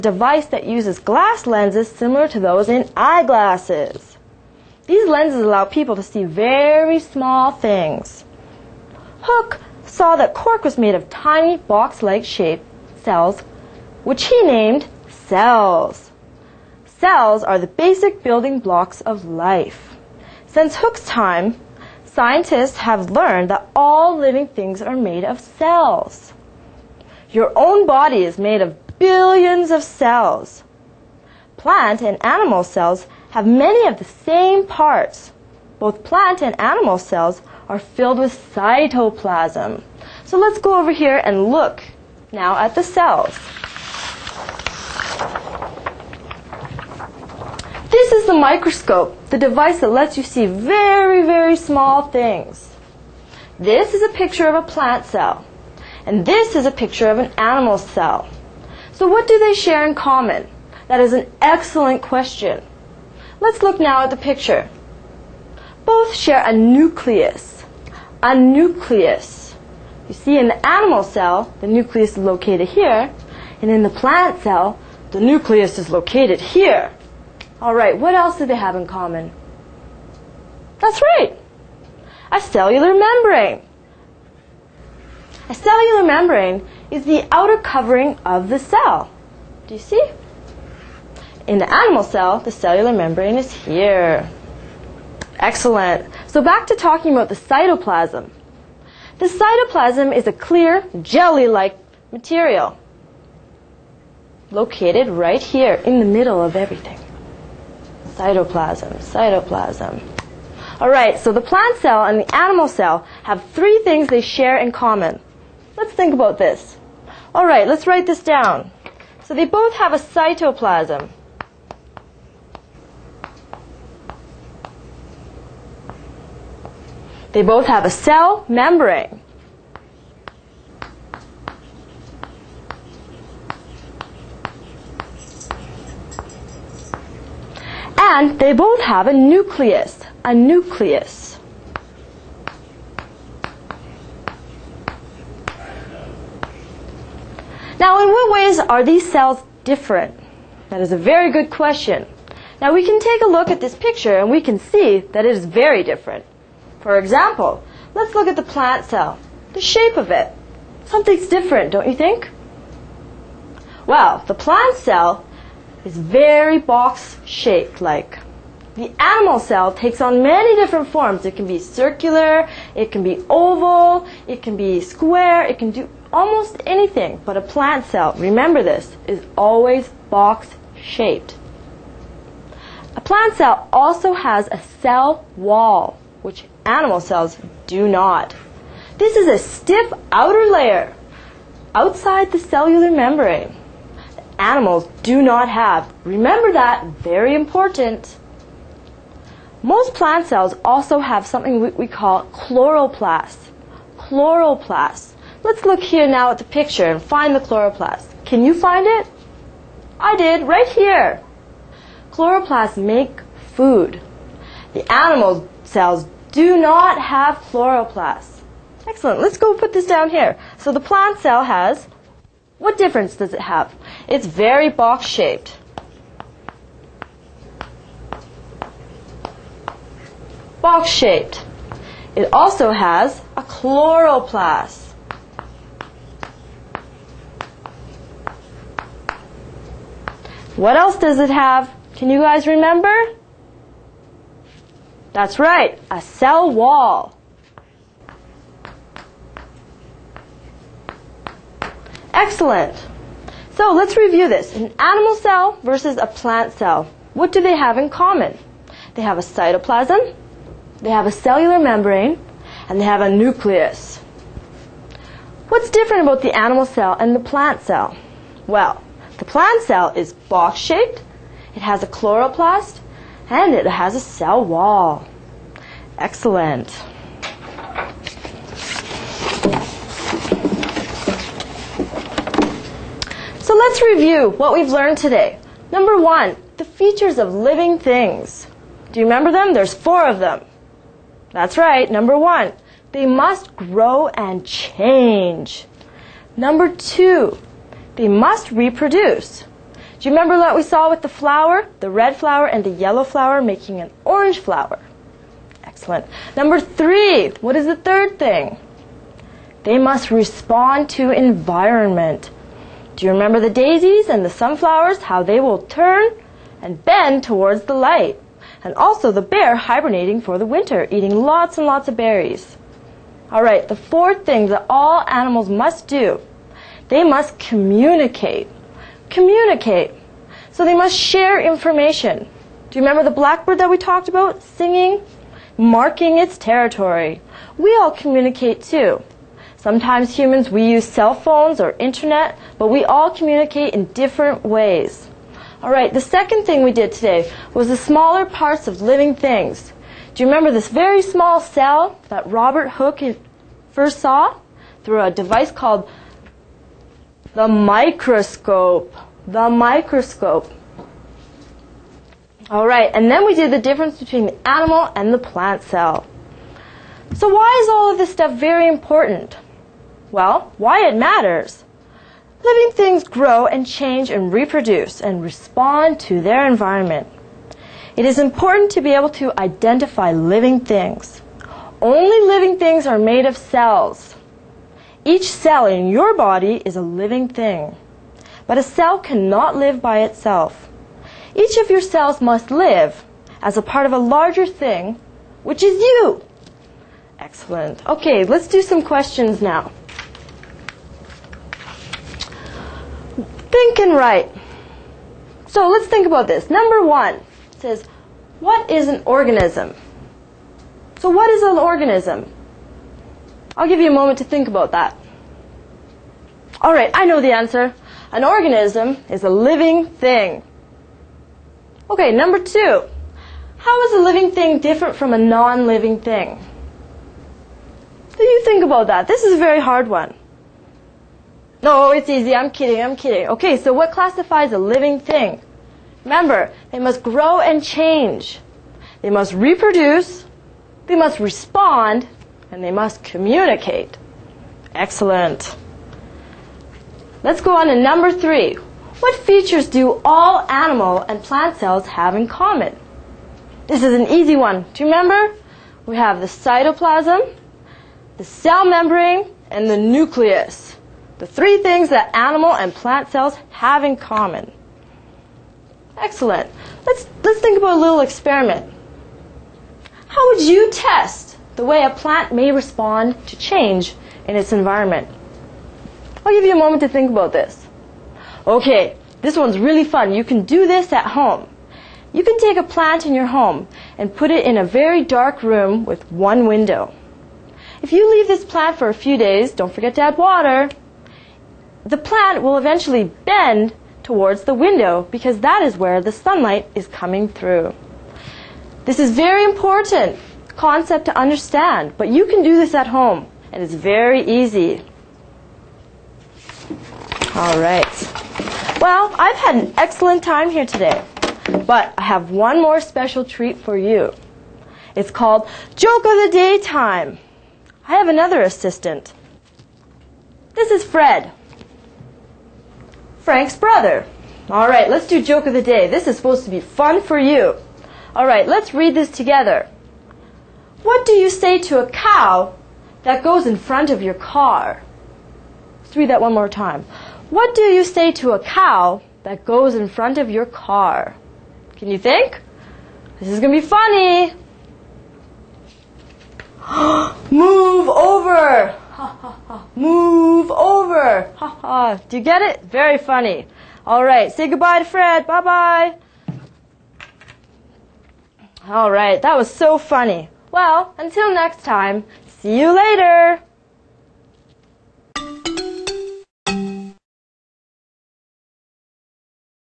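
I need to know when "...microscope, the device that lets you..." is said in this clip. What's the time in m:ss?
0:48.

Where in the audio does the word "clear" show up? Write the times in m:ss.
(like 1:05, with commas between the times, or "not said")
1:40.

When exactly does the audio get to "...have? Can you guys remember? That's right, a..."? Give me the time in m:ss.
4:01.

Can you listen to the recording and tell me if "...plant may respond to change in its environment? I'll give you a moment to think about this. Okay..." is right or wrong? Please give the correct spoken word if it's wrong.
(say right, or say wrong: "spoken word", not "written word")
right.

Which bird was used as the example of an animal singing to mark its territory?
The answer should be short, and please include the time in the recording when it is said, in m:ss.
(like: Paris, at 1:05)
blackbird, at 5:33.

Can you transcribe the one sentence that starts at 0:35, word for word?
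Both plant and animal cells are filled with cytoplasm.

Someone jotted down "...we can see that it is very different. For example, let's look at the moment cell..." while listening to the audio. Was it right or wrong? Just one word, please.
wrong.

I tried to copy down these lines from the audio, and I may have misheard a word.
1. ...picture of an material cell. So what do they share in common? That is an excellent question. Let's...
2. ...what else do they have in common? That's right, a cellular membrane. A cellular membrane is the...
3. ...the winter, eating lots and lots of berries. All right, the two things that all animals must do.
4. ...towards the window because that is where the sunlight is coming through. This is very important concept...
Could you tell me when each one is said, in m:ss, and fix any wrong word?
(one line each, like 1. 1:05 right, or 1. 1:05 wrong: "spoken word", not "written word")
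1. 0:56 wrong: "animal", not "material"
2. 1:17 right
3. 5:20 wrong: "four", not "two"
4. 8:14 right.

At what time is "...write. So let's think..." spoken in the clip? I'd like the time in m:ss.
6:43.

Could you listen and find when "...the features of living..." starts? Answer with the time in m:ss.
4:46.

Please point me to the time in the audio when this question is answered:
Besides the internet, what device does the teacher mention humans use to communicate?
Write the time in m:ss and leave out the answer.
5:40.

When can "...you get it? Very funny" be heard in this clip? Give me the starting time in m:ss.
9:12.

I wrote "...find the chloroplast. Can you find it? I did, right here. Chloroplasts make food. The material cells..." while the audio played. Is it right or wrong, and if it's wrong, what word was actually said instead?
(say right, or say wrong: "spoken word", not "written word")
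wrong: "animal", not "material".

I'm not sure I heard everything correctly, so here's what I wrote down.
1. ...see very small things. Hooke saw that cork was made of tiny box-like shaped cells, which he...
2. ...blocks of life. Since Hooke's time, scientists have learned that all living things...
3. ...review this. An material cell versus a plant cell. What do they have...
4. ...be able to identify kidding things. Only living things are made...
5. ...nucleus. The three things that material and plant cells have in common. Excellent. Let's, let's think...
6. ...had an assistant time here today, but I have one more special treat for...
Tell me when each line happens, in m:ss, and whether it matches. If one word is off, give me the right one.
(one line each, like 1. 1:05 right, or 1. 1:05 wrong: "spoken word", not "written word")
1. 0:06 right
2. 0:18 right
3. 4:13 wrong: "animal", not "material"
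4. 6:18 wrong: "living", not "kidding"
5. 7:39 wrong: "animal", not "material"
6. 8:29 wrong: "excellent", not "assistant".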